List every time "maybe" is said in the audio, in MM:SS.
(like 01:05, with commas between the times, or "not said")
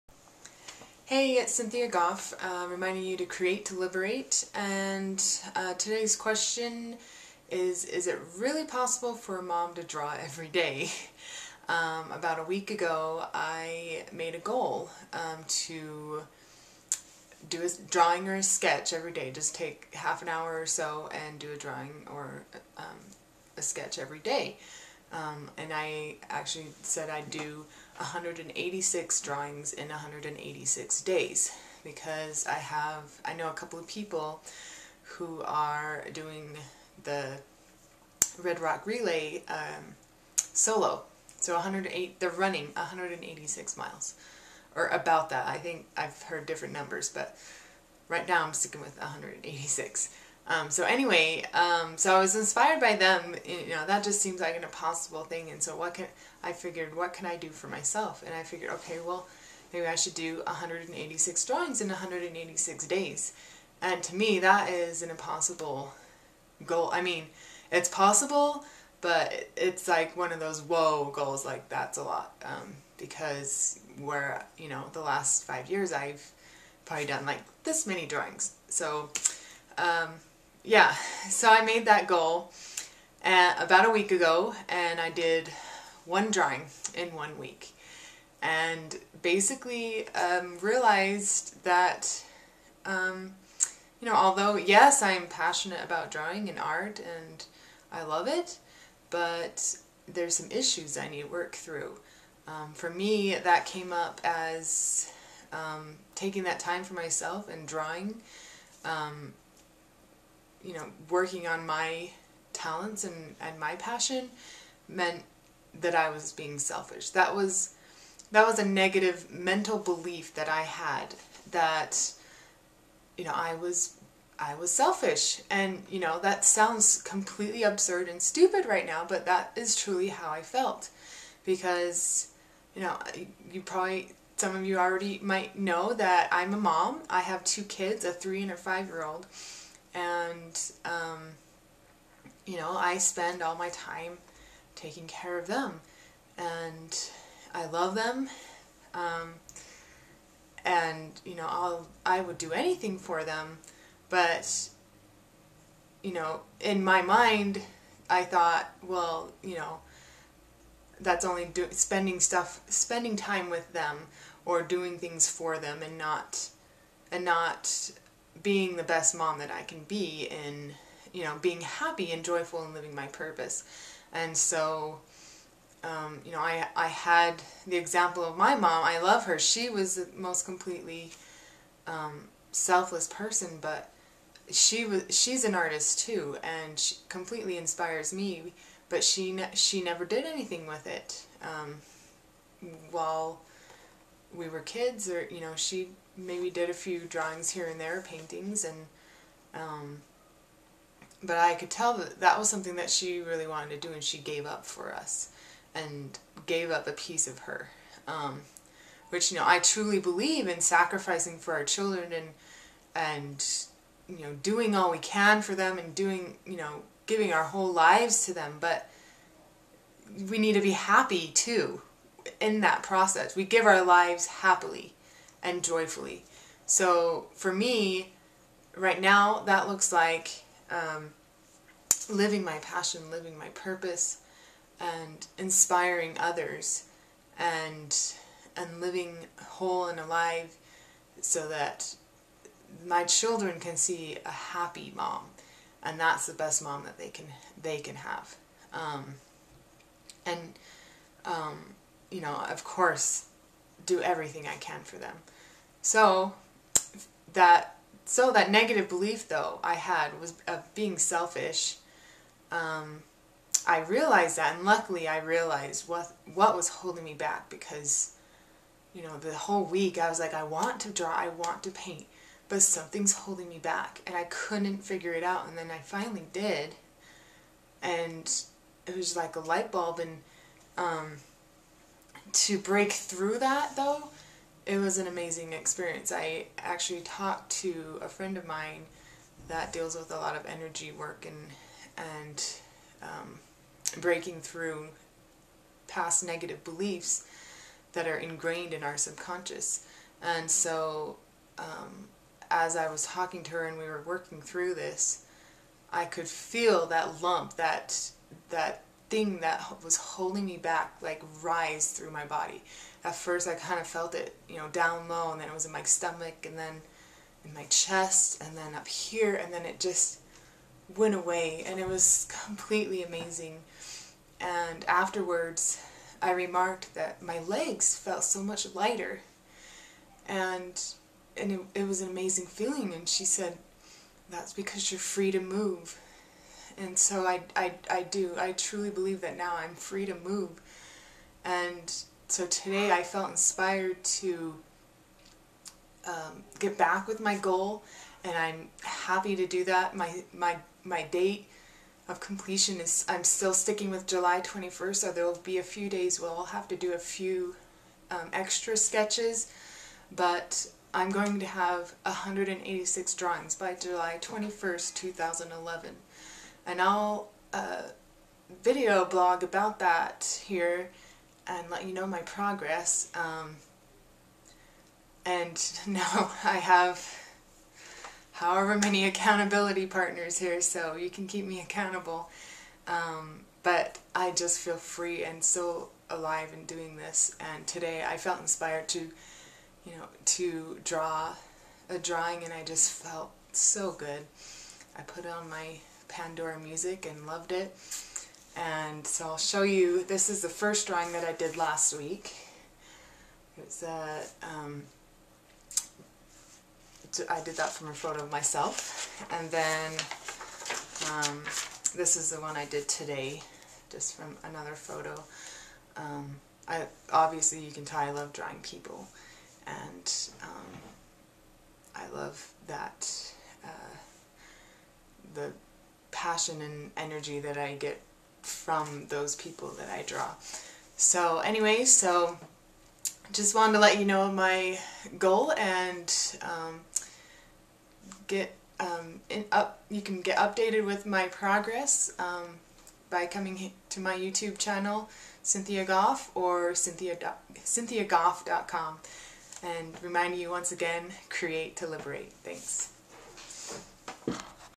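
00:59, 03:16.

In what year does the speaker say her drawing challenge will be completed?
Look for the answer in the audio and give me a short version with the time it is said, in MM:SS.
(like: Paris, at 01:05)
2011, at 06:04.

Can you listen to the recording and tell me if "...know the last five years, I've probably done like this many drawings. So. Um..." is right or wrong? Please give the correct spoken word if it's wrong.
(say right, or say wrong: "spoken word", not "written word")
right.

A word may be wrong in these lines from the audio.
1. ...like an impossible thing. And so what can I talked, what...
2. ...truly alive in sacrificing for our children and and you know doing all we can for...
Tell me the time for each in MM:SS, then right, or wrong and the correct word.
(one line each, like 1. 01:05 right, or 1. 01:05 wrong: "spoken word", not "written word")
1. 00:54 wrong: "figured", not "talked"
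2. 03:29 wrong: "believe", not "alive".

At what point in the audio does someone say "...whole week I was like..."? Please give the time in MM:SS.
04:29.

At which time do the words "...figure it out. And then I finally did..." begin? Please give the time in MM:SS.
04:34.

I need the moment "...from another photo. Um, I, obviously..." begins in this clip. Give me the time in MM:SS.
06:54.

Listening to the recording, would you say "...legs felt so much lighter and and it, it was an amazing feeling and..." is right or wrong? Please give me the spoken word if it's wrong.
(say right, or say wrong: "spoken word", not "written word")
right.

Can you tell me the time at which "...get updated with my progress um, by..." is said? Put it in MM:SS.
07:20.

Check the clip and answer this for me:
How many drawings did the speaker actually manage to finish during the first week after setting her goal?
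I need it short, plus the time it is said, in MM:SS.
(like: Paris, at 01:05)
1, at 01:26.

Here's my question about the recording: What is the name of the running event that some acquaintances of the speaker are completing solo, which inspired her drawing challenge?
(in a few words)
Red Rock Relay.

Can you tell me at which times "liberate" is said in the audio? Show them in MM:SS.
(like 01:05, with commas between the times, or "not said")
00:03, 07:31.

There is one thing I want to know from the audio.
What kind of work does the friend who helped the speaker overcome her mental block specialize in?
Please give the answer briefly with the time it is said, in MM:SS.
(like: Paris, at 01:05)
energy work, at 04:50.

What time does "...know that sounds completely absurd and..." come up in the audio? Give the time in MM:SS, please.
02:05.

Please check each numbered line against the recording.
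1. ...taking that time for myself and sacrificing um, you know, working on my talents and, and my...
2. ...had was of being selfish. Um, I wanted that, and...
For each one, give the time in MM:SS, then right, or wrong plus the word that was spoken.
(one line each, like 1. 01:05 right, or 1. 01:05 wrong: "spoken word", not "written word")
1. 01:46 wrong: "drawing", not "sacrificing"
2. 04:19 wrong: "realized", not "wanted".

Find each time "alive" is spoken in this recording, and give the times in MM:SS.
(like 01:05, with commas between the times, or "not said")
03:59, 06:26.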